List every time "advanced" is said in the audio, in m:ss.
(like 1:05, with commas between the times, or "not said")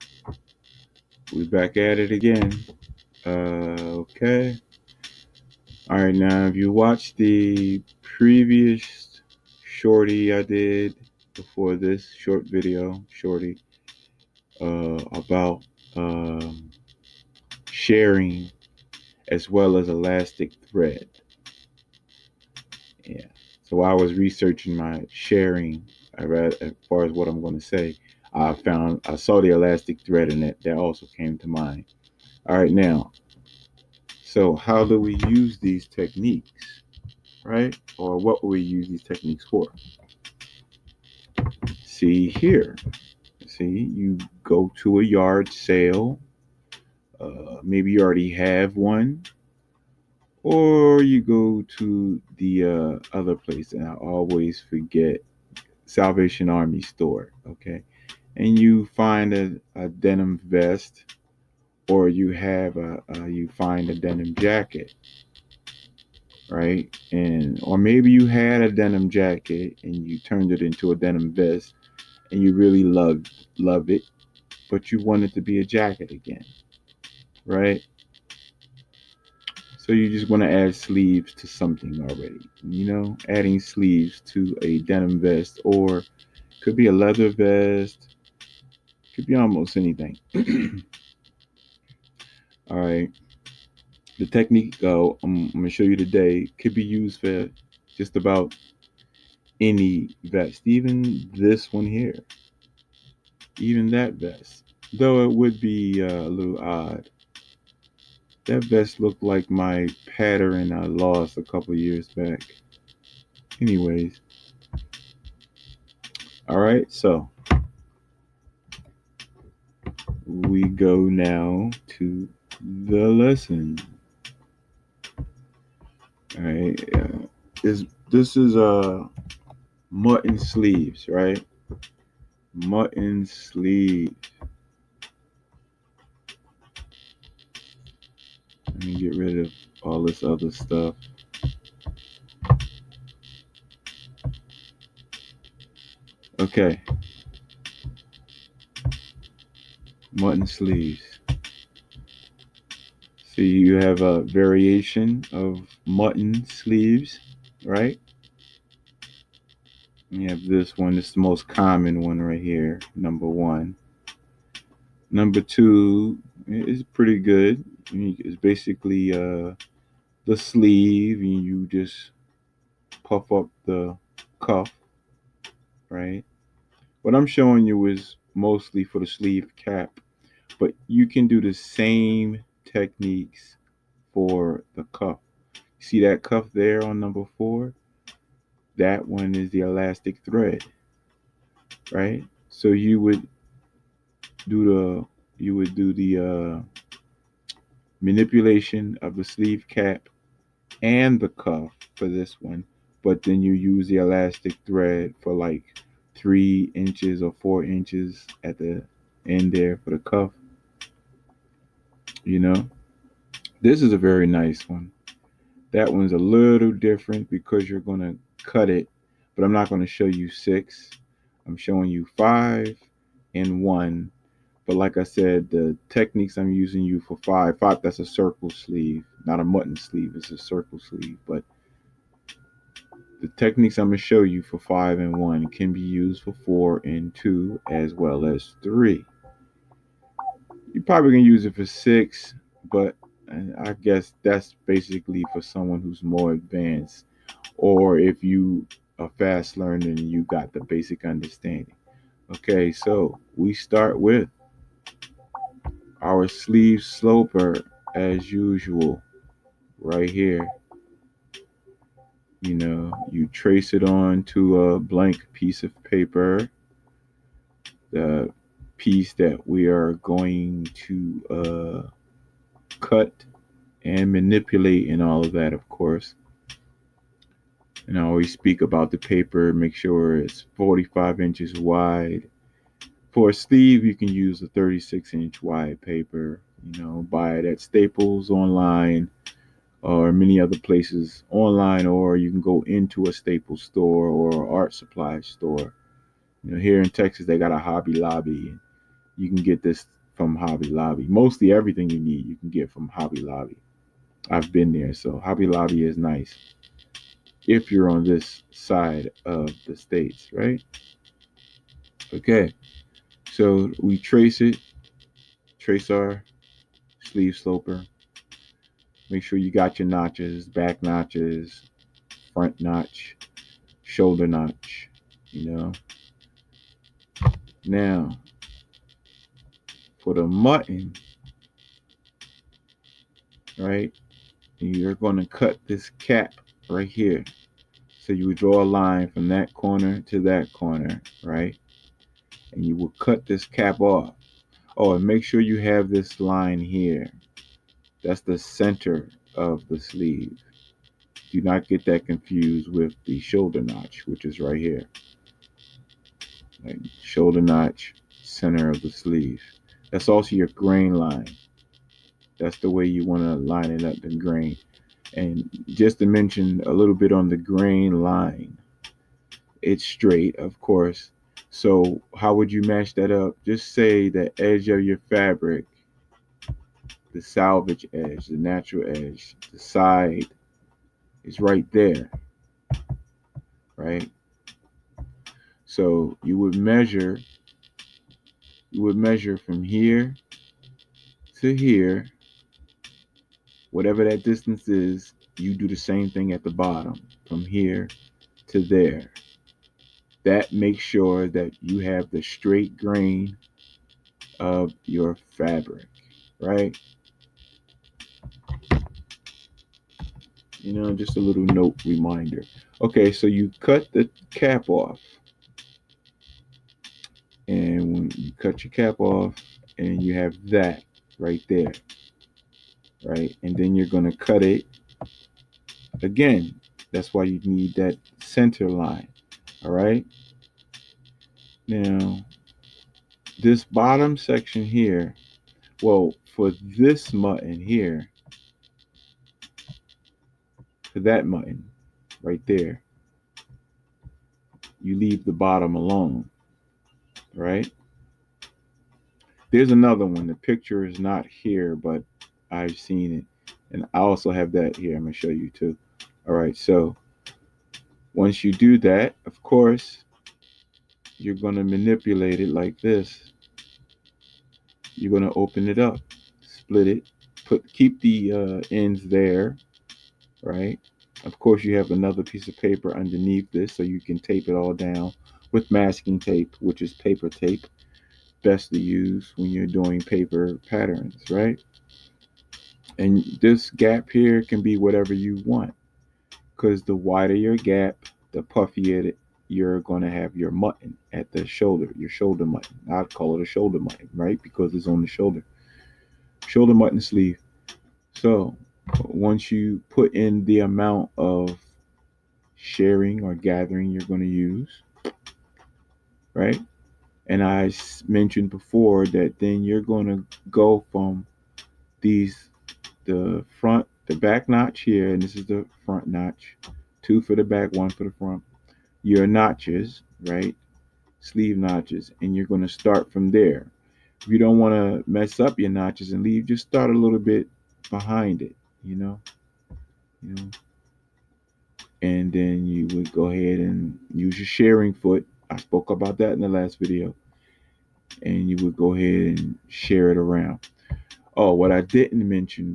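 4:06.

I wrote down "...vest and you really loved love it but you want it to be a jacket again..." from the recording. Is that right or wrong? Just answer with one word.
right.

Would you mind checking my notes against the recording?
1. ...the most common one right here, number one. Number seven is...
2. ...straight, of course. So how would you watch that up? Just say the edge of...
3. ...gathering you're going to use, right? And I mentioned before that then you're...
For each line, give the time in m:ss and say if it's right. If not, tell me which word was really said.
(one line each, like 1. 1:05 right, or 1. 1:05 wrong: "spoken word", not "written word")
1. 2:41 wrong: "two", not "seven"
2. 6:09 wrong: "match", not "watch"
3. 8:23 right.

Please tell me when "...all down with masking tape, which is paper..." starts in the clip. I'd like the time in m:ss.
7:54.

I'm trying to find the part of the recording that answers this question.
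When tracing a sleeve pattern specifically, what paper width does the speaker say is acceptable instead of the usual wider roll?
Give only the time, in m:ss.
4:44.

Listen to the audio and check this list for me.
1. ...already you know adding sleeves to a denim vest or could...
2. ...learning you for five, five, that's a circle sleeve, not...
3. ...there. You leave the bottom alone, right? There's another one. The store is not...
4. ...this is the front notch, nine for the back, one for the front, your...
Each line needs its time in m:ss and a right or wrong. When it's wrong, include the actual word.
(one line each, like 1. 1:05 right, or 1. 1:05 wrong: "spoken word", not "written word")
1. 1:22 right
2. 3:46 wrong: "using", not "learning"
3. 7:22 wrong: "picture", not "store"
4. 8:35 wrong: "two", not "nine".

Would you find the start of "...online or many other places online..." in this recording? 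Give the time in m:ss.
4:48.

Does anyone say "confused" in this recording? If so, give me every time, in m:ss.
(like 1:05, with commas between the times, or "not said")
5:52.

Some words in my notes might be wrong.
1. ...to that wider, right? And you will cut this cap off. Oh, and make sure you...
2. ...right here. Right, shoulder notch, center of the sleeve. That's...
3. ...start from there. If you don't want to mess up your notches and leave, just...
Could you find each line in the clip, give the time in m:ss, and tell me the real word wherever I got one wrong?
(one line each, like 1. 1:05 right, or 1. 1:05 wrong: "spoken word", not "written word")
1. 5:40 wrong: "corner", not "wider"
2. 5:54 right
3. 8:42 right.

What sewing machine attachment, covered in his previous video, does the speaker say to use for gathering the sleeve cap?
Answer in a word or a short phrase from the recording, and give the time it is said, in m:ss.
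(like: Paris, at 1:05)
shirring foot, at 8:54.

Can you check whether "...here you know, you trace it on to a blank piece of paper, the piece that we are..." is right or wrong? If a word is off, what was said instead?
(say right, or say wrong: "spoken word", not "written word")
right.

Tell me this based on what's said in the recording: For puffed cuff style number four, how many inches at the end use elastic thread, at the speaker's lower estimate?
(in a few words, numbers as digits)
3.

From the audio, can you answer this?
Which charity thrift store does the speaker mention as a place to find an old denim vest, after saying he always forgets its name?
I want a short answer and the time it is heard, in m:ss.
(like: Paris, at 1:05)
Salvation Army, at 0:55.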